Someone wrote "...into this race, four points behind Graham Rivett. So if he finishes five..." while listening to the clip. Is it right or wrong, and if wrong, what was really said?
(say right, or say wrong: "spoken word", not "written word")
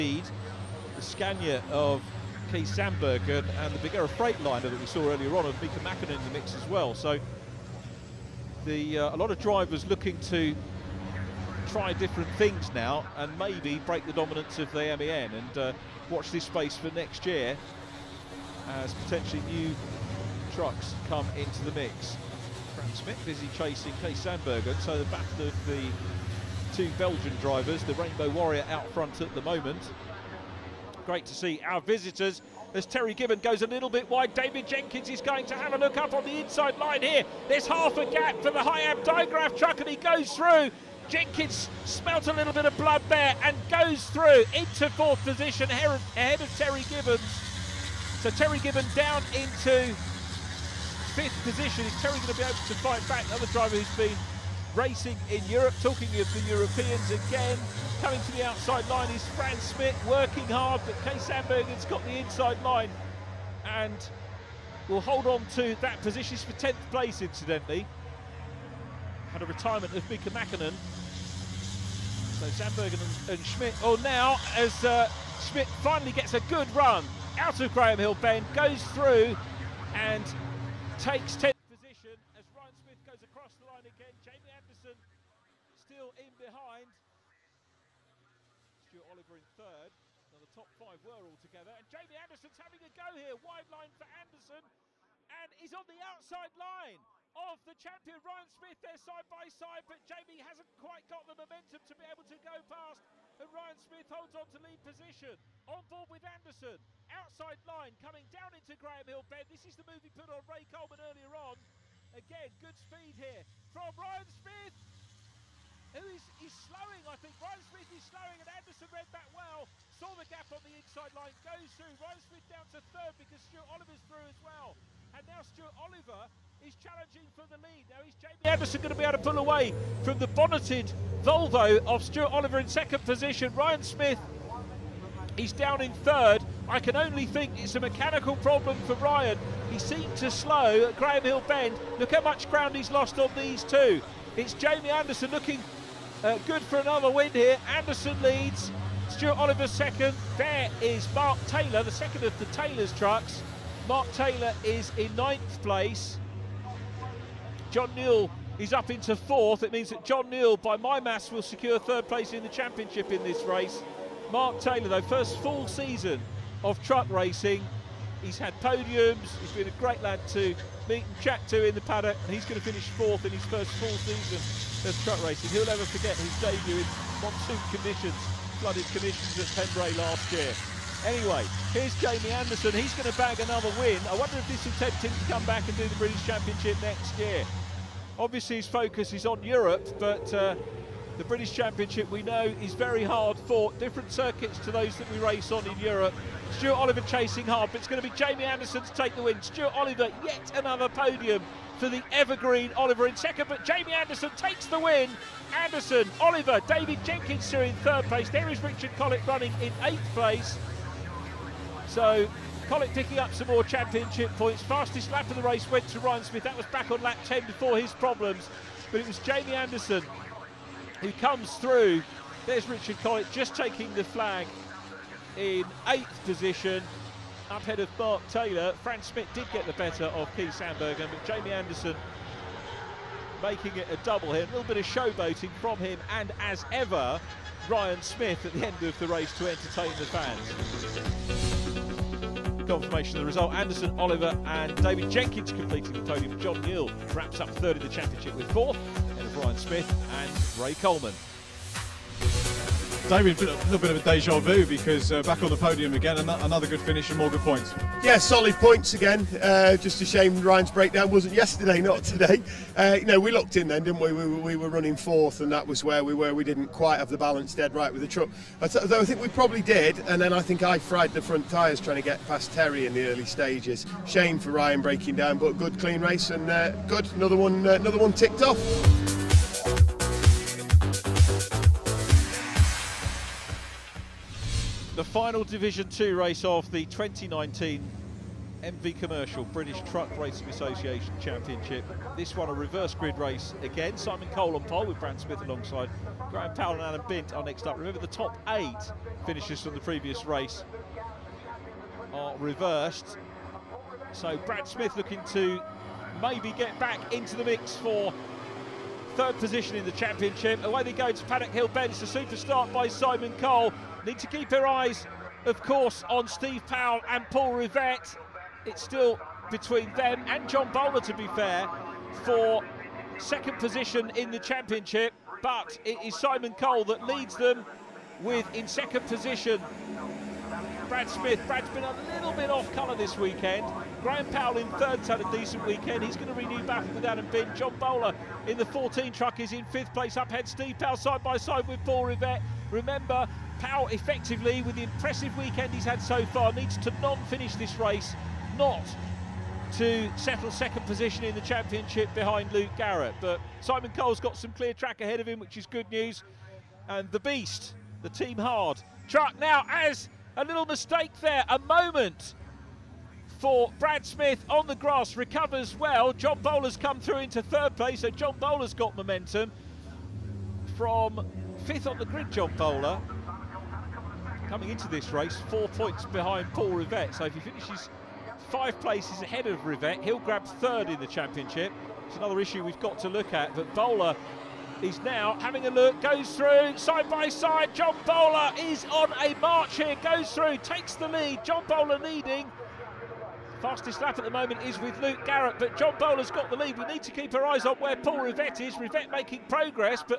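wrong: "Paul", not "Graham".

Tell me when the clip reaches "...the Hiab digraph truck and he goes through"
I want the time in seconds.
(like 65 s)
38 s.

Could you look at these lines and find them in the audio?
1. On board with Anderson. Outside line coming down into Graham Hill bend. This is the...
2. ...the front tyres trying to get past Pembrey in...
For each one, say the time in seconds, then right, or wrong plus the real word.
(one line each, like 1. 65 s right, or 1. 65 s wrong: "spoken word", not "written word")
1. 105 s right
2. 271 s wrong: "Terry", not "Pembrey".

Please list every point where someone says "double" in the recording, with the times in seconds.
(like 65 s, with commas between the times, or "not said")
234 s.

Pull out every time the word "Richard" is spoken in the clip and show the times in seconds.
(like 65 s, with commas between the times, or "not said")
208 s, 222 s.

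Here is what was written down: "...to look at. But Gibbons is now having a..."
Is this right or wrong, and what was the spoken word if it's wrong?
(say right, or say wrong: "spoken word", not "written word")
wrong: "Bowler", not "Gibbons".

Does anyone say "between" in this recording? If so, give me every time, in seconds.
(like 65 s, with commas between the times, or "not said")
319 s.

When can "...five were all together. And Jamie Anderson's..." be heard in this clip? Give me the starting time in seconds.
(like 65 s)
90 s.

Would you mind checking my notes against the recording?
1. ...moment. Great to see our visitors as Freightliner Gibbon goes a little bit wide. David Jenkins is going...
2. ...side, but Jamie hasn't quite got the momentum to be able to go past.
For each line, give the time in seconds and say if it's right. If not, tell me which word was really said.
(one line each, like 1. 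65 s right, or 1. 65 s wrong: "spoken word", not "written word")
1. 29 s wrong: "Terry", not "Freightliner"
2. 99 s right.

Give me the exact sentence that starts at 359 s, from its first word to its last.
Truck now as a little mistake there, a moment for Brad Smith on the grass, recovers well.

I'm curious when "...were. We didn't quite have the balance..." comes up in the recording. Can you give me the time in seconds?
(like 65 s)
266 s.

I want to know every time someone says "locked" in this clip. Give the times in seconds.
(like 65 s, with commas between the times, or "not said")
263 s.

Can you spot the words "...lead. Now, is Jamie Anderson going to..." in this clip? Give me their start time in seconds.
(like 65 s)
127 s.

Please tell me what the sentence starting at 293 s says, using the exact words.
Simon Cole on pole with Brad Smith alongside Graham Powell and Adam Bint are next up.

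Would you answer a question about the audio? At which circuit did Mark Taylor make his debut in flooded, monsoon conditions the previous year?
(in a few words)
Pembrey.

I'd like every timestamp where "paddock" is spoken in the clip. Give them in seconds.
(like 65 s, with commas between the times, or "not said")
171 s, 311 s.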